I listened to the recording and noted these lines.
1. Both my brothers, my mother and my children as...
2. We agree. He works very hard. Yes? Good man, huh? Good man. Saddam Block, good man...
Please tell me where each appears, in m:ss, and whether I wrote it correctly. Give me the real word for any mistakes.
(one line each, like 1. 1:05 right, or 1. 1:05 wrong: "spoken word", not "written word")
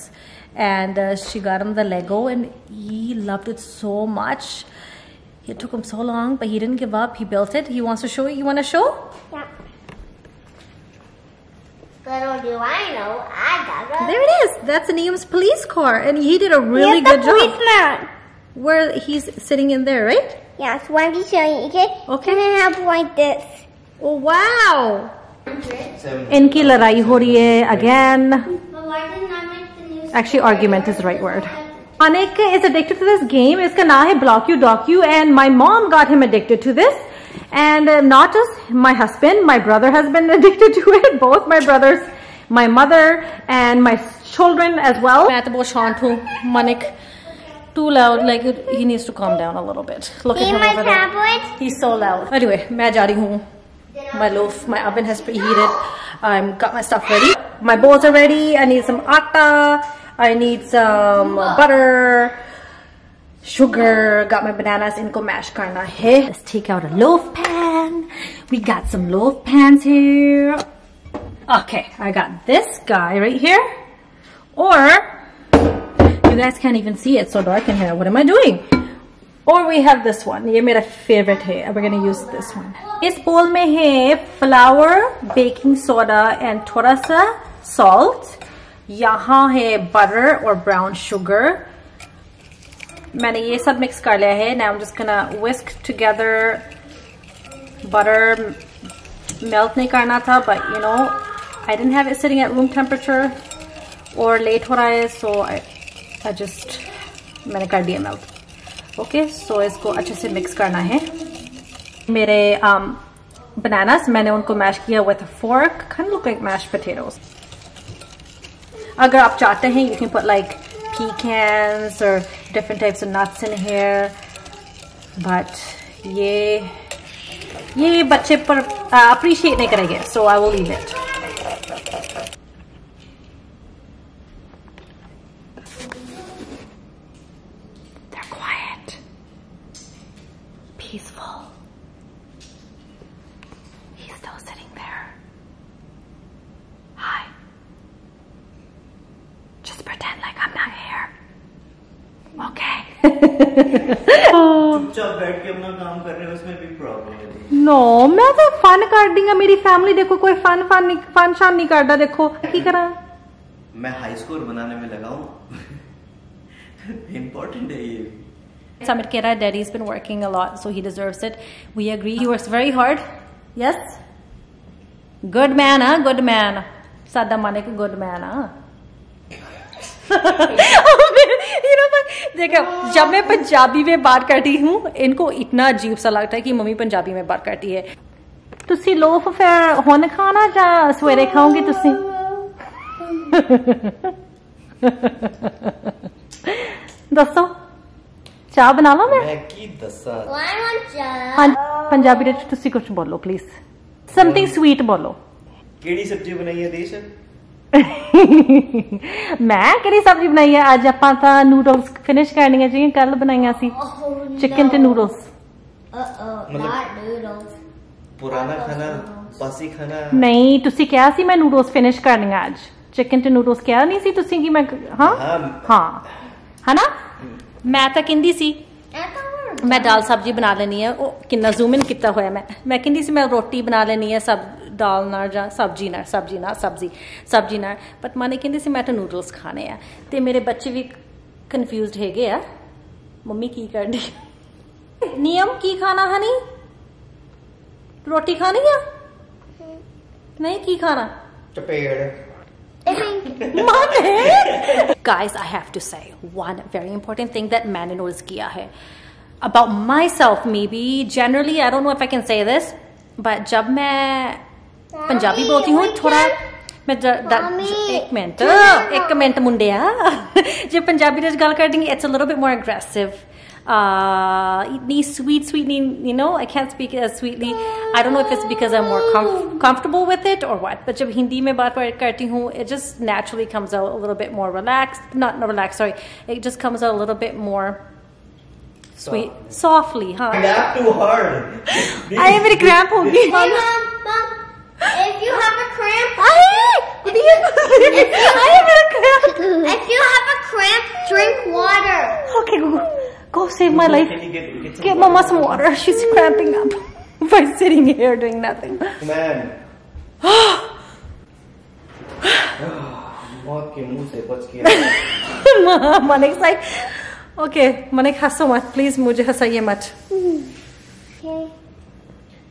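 1. 0:41 right
2. 2:51 wrong: "Manik", not "Block".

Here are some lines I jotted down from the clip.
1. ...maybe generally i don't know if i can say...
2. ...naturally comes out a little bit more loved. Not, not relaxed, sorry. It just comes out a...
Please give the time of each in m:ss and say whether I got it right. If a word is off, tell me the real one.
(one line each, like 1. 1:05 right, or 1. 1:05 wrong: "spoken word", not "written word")
1. 4:20 right
2. 4:43 wrong: "relaxed", not "loved".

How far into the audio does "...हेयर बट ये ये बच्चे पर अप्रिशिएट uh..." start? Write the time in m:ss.
2:03.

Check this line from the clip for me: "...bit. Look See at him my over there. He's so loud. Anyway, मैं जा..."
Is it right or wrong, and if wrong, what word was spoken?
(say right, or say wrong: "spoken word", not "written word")
right.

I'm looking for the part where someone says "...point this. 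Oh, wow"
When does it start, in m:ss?
0:22.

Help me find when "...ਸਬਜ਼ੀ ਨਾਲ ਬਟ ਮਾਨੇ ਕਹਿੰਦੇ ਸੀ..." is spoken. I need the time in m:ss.
3:57.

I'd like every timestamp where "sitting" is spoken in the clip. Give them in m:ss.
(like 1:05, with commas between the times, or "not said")
0:19, 1:42, 5:07.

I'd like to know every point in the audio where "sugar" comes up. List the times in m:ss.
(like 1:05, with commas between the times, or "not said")
1:03, 1:31.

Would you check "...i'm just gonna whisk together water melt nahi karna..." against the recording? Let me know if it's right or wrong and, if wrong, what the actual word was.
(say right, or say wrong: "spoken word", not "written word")
wrong: "butter", not "water".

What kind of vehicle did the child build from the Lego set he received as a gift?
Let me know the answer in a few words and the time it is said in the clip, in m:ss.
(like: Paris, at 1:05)
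Police car, at 0:15.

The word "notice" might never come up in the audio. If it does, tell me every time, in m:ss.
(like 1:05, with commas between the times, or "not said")
4:17.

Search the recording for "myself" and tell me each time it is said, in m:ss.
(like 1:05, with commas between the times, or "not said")
4:19.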